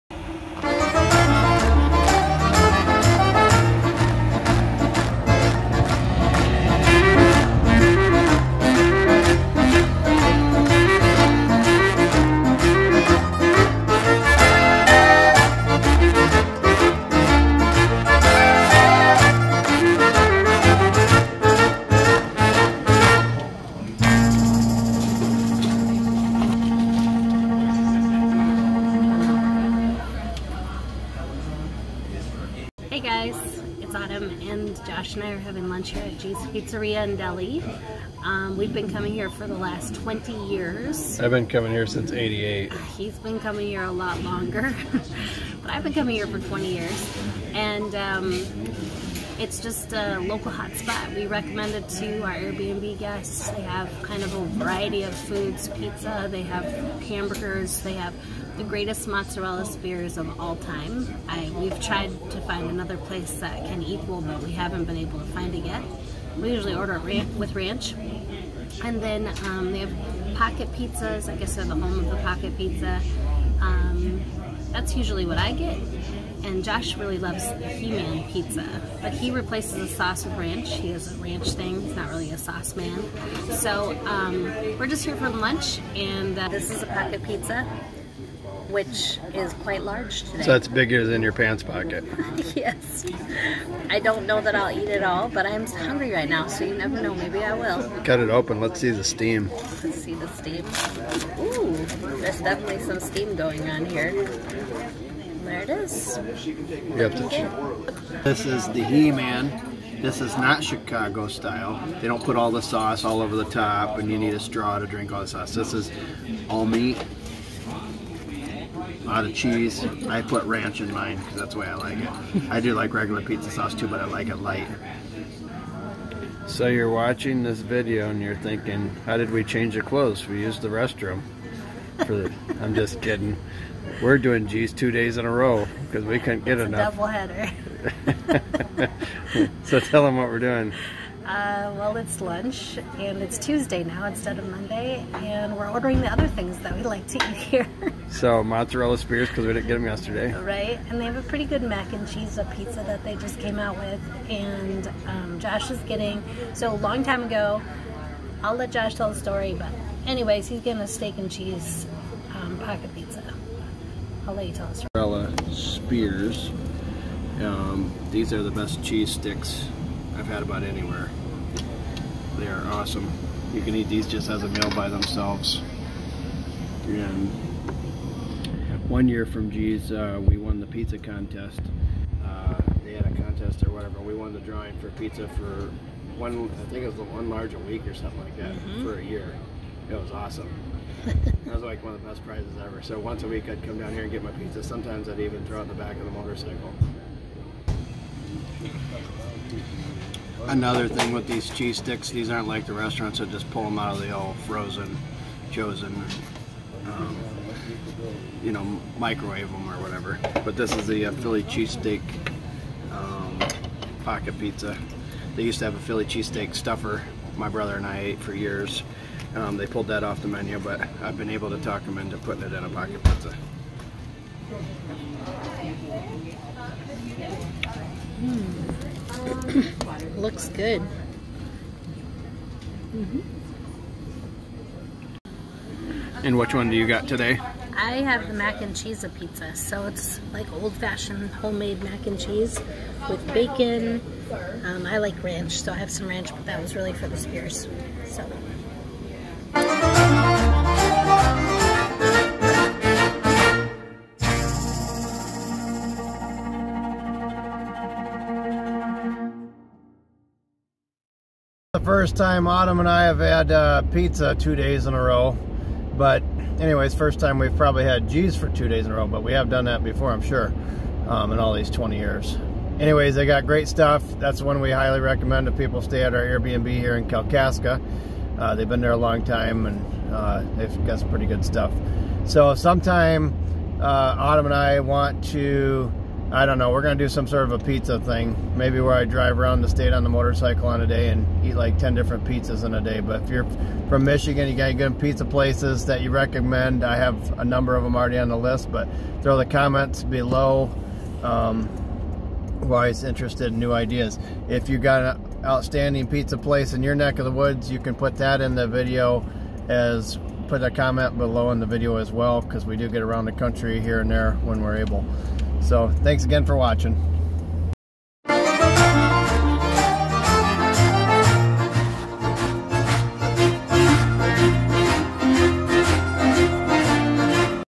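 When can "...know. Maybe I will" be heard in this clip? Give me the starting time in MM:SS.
01:37.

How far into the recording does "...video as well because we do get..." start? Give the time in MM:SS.
05:11.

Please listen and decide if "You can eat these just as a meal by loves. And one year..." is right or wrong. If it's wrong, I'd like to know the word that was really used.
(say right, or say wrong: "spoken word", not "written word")
wrong: "themselves", not "loves".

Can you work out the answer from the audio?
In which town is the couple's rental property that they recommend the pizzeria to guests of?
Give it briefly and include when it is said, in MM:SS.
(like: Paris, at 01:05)
Kalkaska, at 04:37.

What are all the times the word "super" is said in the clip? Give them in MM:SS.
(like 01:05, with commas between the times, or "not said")
not said.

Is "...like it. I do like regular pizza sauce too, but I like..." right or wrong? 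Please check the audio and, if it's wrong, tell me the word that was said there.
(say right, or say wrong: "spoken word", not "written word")
right.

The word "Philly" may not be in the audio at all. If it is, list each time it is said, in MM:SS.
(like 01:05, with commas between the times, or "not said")
03:31, 03:35.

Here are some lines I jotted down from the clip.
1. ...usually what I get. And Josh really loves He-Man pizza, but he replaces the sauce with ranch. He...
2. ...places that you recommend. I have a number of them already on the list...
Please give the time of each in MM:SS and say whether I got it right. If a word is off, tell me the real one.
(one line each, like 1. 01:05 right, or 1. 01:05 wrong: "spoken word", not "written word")
1. 01:14 right
2. 04:55 right.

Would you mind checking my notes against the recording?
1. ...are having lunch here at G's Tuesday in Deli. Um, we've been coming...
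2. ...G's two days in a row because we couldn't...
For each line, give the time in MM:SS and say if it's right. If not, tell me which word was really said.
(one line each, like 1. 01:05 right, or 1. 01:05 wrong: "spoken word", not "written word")
1. 00:35 wrong: "Pizzeria", not "Tuesday"
2. 02:14 right.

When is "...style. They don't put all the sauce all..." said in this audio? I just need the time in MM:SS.
01:51.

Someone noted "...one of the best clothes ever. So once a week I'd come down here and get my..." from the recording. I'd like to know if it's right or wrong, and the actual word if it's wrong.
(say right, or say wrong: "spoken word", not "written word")
wrong: "prizes", not "clothes".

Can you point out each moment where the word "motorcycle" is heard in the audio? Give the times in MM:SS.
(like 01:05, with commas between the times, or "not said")
03:16, 04:50.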